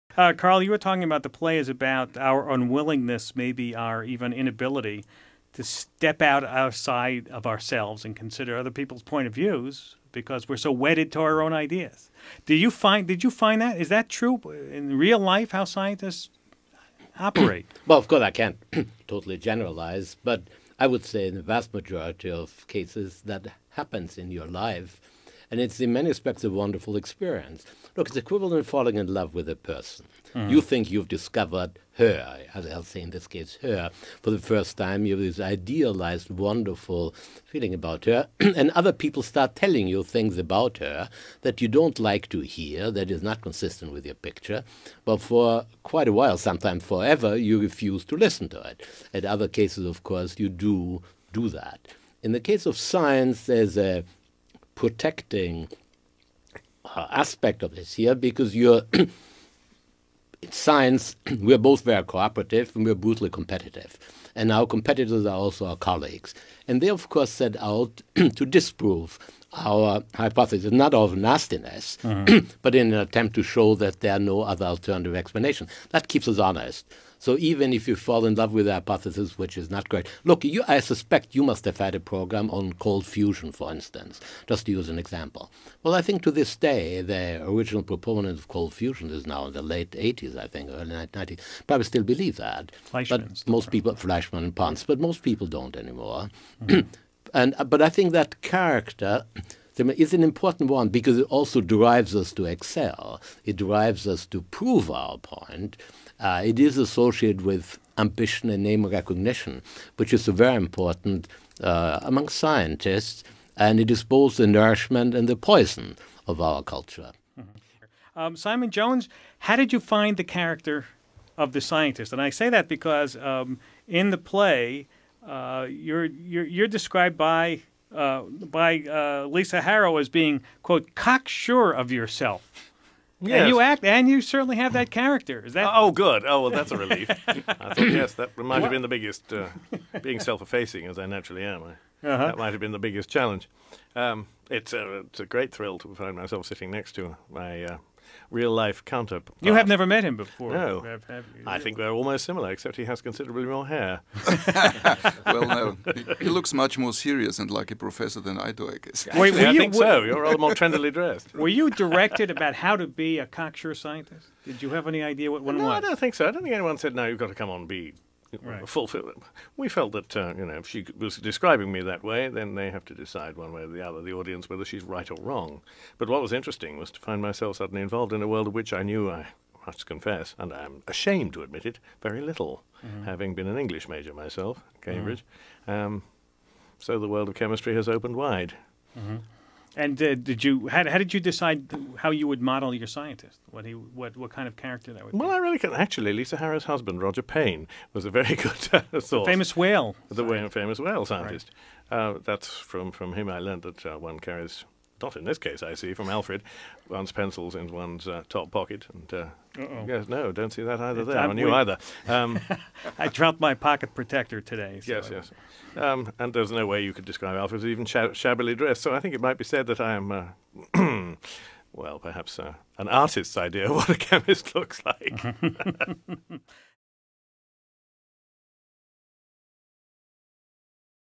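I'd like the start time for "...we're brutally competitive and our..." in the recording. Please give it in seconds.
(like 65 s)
62 s.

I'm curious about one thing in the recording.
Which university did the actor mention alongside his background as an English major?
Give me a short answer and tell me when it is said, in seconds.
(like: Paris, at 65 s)
Cambridge, at 184 s.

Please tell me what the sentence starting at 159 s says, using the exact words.
Wait, Actually, I you, think were, so.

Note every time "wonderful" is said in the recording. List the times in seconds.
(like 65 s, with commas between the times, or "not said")
26 s, 36 s.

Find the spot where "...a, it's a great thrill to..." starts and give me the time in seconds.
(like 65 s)
144 s.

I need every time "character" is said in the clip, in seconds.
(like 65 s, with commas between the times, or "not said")
98 s, 120 s, 134 s, 194 s.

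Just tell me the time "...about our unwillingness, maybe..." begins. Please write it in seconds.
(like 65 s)
1 s.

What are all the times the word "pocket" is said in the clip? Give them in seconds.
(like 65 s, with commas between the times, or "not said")
208 s, 213 s.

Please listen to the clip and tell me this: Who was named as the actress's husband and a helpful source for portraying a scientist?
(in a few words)
Roger Payne.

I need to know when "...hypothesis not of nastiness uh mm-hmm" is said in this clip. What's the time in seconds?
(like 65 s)
70 s.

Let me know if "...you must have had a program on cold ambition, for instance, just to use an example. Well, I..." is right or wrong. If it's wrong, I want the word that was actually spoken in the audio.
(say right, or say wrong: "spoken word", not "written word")
wrong: "fusion", not "ambition".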